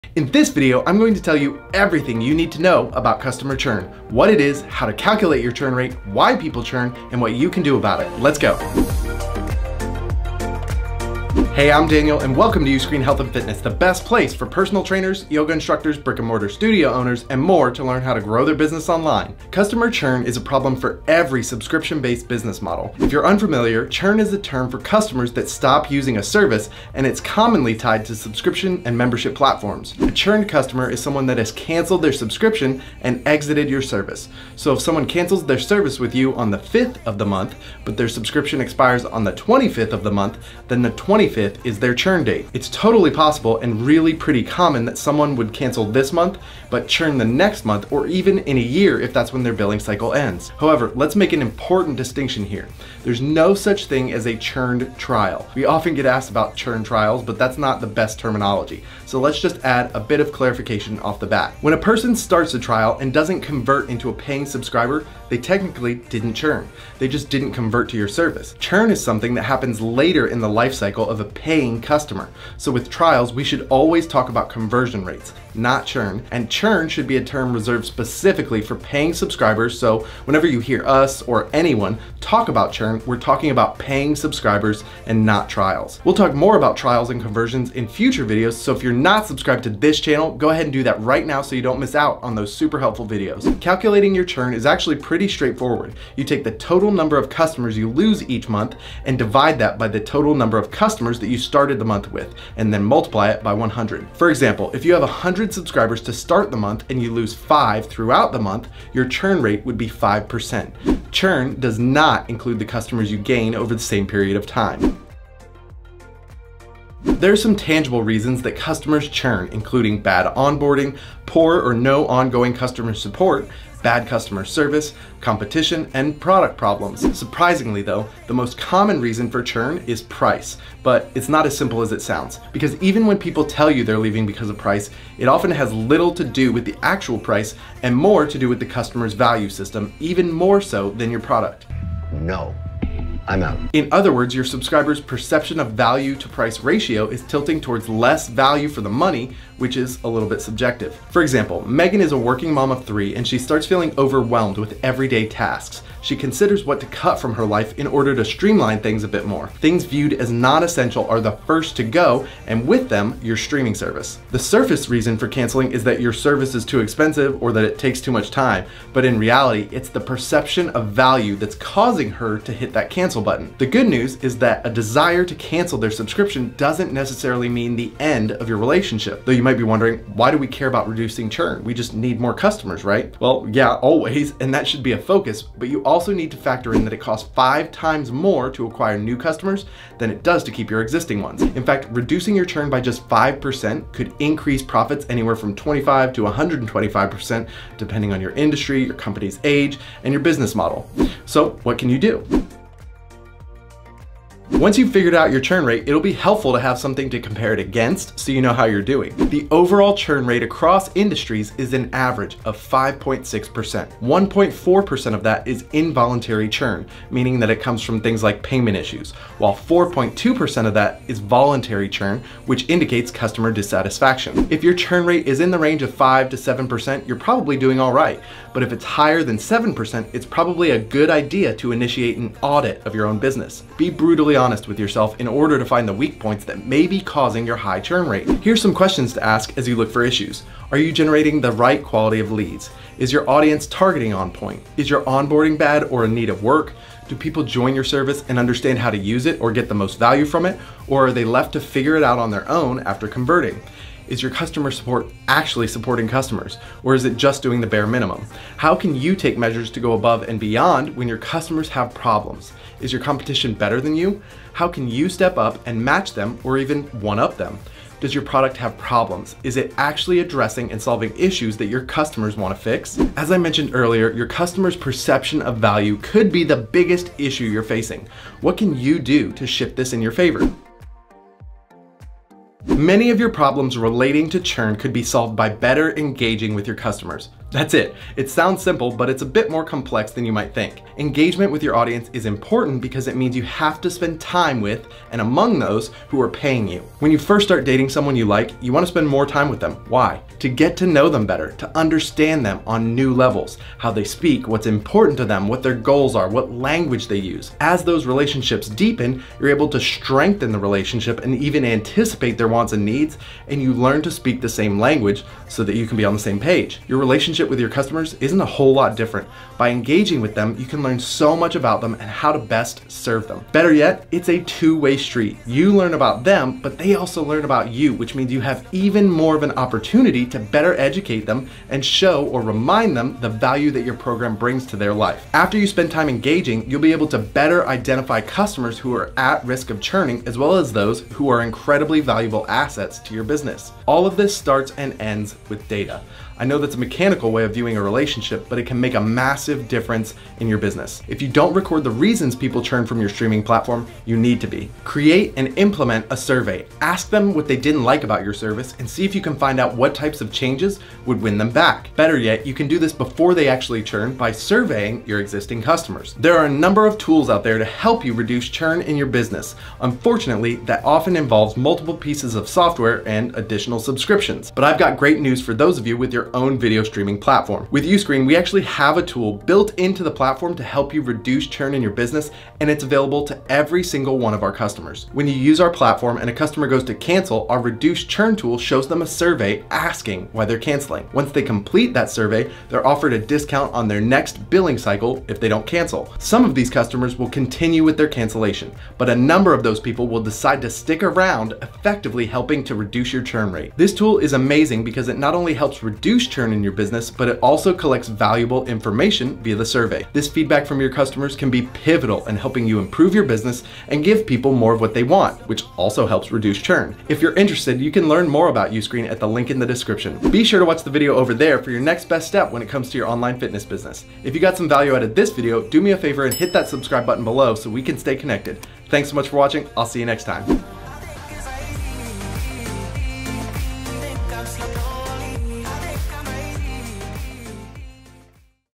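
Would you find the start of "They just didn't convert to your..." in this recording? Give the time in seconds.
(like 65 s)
66 s.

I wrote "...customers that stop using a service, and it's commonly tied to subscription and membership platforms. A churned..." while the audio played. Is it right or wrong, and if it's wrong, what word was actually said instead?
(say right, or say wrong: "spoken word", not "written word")
right.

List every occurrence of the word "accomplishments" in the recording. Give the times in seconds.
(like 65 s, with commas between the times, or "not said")
not said.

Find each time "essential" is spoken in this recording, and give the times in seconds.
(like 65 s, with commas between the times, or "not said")
160 s.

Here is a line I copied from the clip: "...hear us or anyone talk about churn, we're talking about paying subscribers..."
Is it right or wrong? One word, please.
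right.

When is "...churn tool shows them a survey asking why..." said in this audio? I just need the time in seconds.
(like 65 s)
388 s.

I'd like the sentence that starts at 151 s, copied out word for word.
For example, Megan is a working mom of three and she starts feeling overwhelmed with everyday tasks.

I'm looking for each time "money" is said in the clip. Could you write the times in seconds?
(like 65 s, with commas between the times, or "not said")
148 s.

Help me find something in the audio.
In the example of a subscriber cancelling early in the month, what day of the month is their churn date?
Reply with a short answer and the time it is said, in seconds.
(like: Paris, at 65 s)
25th, at 39 s.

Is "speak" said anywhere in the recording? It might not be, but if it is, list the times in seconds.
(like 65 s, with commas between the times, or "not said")
304 s, 314 s.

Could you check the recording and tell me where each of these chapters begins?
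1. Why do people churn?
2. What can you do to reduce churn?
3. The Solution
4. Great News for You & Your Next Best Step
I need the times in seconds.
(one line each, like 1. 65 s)
1. 115 s
2. 202 s
3. 280 s
4. 375 s.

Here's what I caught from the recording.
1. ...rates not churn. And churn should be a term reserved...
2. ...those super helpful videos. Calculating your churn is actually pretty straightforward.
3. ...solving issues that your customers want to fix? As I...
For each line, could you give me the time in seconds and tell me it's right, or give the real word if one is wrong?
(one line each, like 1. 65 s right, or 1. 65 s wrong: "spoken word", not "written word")
1. 75 s right
2. 92 s right
3. 270 s right.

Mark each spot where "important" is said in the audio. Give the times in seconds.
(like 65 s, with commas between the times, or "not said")
51 s, 292 s, 304 s.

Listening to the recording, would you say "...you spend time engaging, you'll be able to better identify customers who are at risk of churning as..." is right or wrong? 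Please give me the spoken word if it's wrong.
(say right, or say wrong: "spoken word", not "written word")
right.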